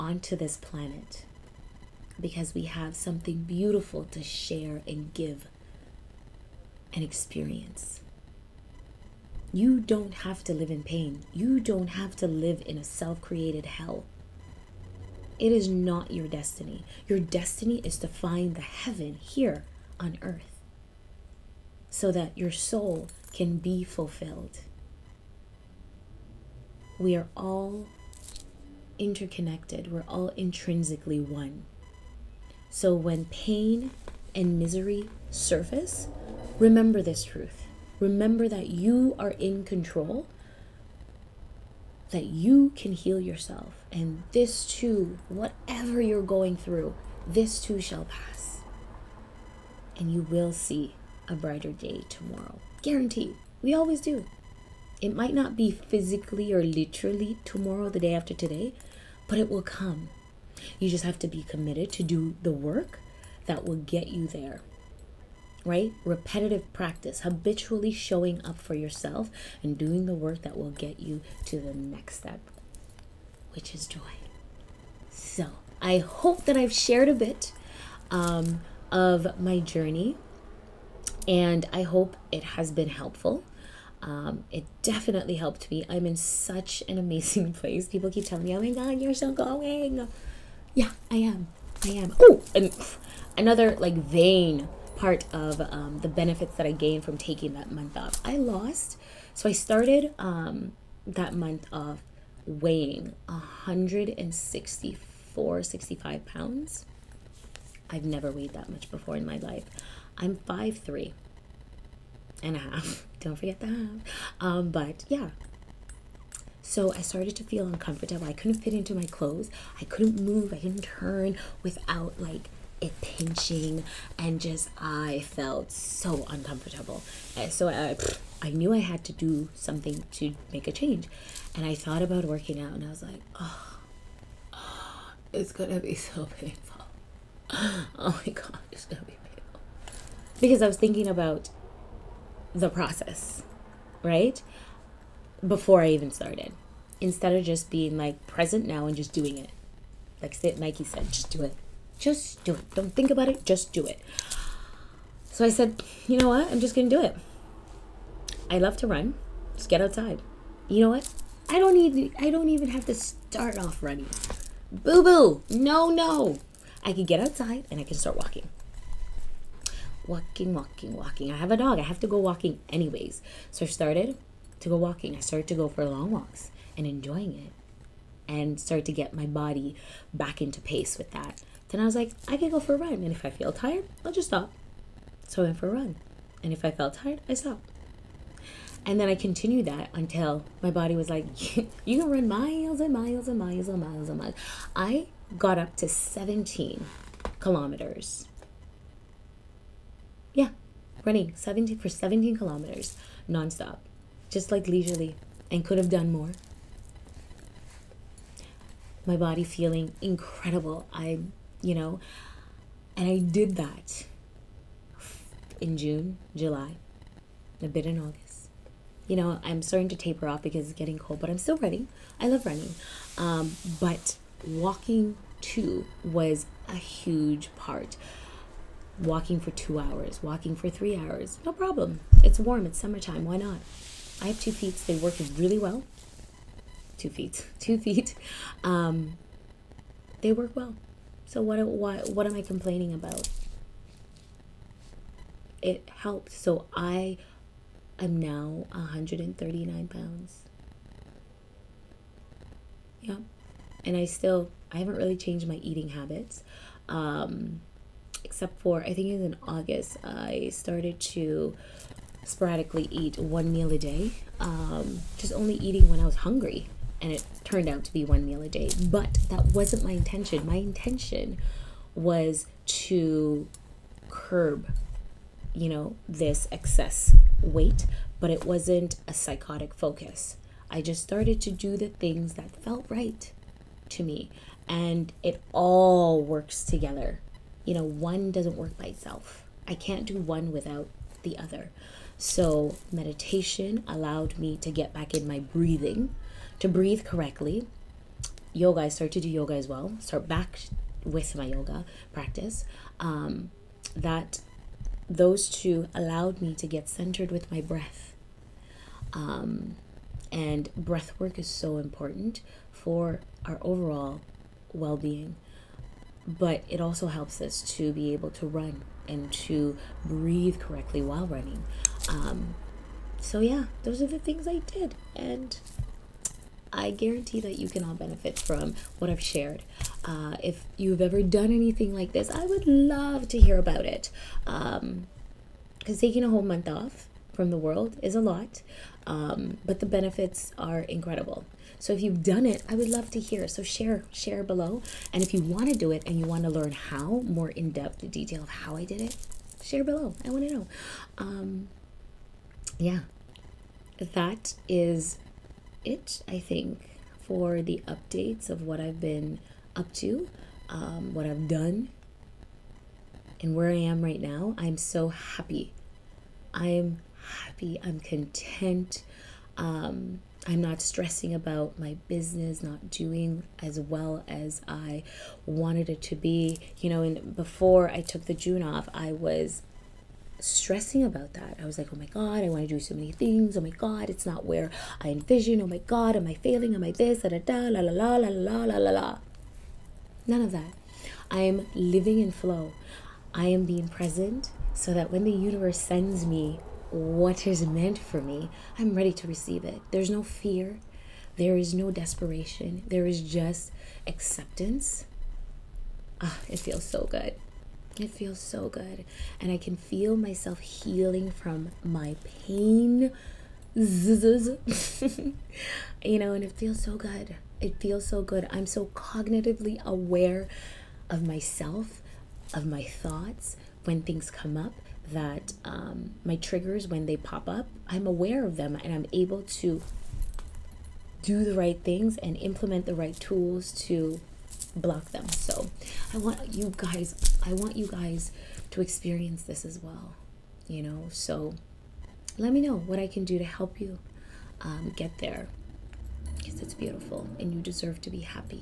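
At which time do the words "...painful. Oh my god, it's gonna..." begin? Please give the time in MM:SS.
02:16.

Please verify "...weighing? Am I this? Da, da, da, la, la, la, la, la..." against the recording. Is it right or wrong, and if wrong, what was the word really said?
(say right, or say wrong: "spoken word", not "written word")
wrong: "failing", not "weighing".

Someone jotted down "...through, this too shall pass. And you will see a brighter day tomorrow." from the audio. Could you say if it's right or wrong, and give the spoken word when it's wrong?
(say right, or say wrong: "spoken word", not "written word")
right.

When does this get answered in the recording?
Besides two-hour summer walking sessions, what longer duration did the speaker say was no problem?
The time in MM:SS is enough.
03:50.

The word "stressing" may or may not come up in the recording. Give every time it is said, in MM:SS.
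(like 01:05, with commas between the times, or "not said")
06:10, 06:20.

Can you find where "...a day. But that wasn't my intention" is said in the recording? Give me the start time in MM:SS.
04:28.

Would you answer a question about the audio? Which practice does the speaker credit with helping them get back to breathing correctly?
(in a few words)
Meditation.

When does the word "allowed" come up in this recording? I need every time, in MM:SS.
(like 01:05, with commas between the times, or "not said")
04:53, 05:05.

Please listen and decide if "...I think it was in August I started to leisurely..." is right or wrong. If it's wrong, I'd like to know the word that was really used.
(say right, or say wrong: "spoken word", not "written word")
wrong: "sporadically", not "leisurely".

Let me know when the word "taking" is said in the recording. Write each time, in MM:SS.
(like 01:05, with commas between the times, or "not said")
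01:37, 05:35.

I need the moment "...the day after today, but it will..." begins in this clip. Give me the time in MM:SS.
00:57.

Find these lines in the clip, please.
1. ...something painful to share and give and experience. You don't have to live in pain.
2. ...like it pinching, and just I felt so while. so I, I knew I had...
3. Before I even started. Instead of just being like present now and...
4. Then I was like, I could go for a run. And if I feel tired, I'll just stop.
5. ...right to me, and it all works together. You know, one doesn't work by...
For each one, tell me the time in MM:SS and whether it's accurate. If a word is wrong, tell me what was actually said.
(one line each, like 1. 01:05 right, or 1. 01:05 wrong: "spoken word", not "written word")
1. 00:02 wrong: "beautiful", not "painful"
2. 02:02 wrong: "uncomfortable", not "while"
3. 02:25 right
4. 03:01 right
5. 04:42 right.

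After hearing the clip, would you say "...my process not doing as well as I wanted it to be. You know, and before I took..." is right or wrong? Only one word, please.
wrong.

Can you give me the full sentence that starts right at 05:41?
So if you've done it, I would love to hear.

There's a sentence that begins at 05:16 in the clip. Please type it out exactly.
But it also helps us to be able to run and to breathe correctly while running.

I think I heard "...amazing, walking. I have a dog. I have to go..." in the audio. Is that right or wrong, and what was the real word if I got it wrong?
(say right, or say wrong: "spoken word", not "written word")
wrong: "walking", not "amazing".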